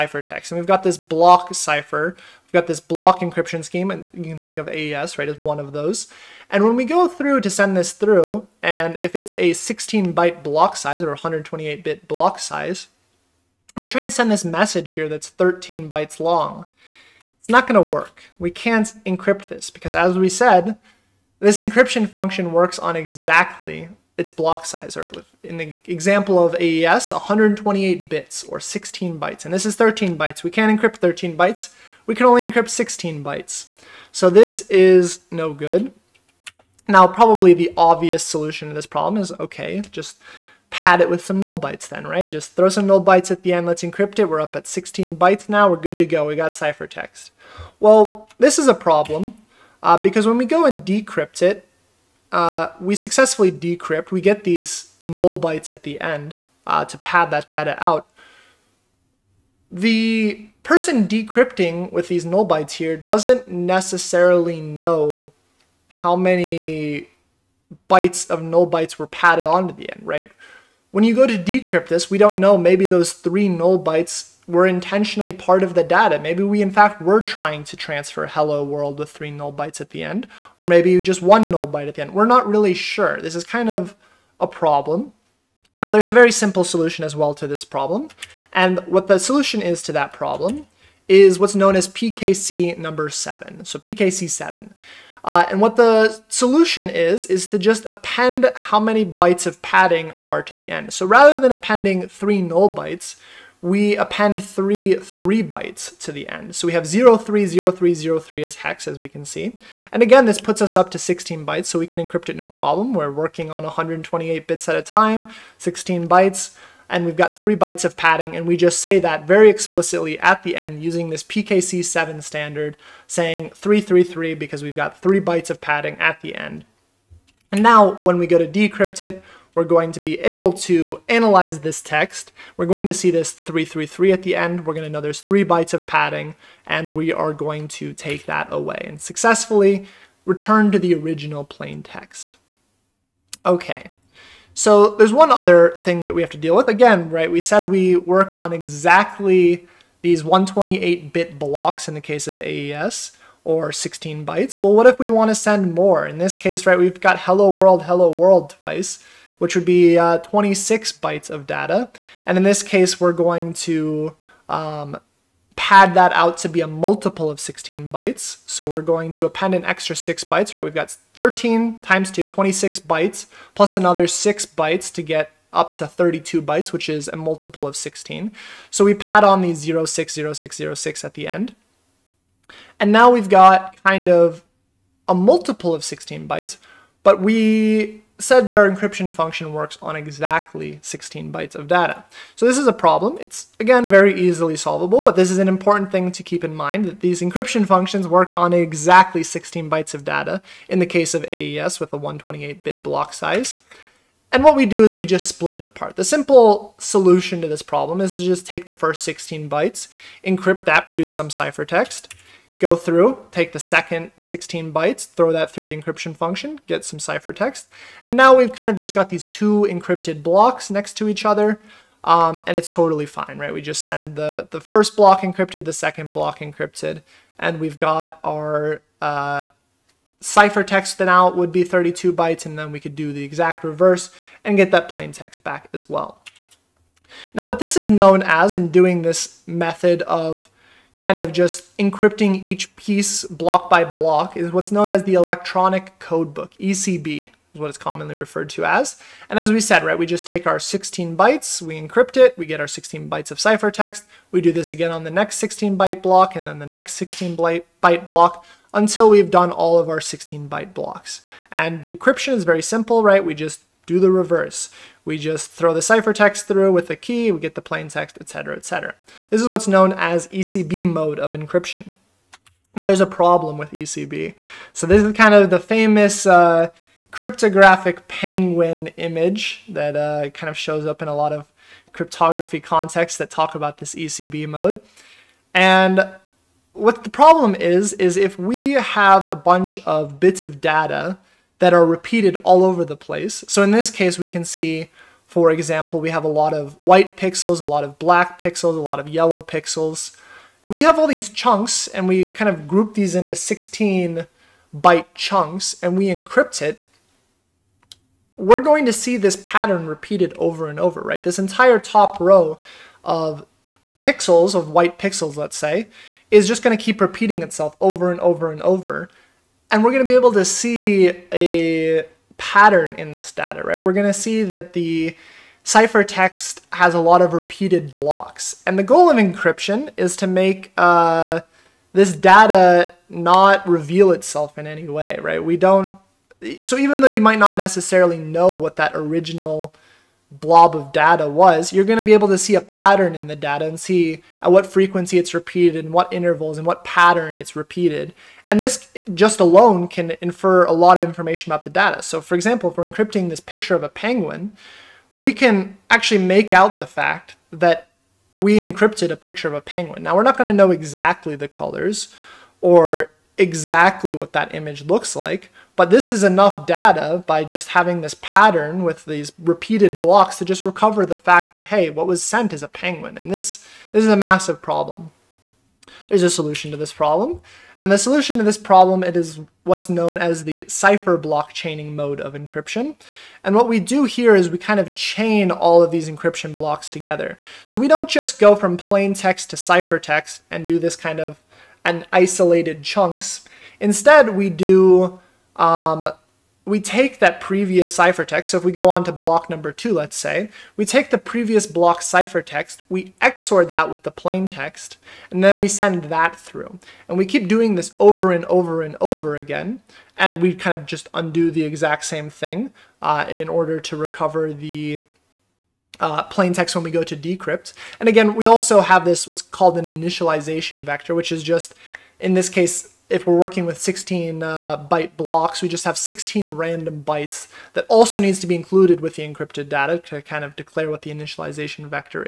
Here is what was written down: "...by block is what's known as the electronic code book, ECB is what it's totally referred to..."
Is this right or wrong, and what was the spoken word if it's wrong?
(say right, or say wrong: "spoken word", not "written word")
wrong: "commonly", not "totally".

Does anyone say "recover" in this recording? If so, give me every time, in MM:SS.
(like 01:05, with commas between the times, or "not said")
06:10, 06:53.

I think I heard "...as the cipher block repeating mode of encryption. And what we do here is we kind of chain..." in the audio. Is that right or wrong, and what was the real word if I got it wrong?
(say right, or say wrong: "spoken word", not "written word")
wrong: "chaining", not "repeating".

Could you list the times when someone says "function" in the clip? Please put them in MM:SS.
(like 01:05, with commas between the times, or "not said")
00:22, 03:09, 03:17, 03:36.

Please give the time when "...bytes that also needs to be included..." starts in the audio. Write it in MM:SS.
07:07.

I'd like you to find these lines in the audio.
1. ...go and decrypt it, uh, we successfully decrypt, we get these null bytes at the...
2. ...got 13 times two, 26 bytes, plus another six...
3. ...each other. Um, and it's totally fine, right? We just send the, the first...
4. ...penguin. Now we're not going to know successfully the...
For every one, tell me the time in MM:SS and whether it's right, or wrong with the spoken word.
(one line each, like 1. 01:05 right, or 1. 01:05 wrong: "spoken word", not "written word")
1. 00:50 right
2. 02:50 right
3. 03:41 right
4. 05:59 wrong: "exactly", not "successfully".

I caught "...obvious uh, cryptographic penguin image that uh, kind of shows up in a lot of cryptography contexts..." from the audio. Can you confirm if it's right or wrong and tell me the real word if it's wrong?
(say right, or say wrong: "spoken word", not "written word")
wrong: "famous", not "obvious".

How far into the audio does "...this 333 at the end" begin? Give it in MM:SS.
02:13.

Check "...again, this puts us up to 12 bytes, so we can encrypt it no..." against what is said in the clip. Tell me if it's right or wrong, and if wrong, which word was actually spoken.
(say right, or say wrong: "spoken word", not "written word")
wrong: "16", not "12".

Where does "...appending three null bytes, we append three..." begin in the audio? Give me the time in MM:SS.
01:41.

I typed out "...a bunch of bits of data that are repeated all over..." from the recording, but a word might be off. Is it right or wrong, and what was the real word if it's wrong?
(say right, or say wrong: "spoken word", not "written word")
right.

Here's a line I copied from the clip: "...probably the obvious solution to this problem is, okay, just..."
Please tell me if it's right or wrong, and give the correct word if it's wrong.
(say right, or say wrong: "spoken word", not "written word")
right.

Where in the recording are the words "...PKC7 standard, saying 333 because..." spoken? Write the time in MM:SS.
02:01.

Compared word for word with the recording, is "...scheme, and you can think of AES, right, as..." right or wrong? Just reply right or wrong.
right.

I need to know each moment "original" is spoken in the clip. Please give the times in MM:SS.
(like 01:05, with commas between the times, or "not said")
02:20, 05:38.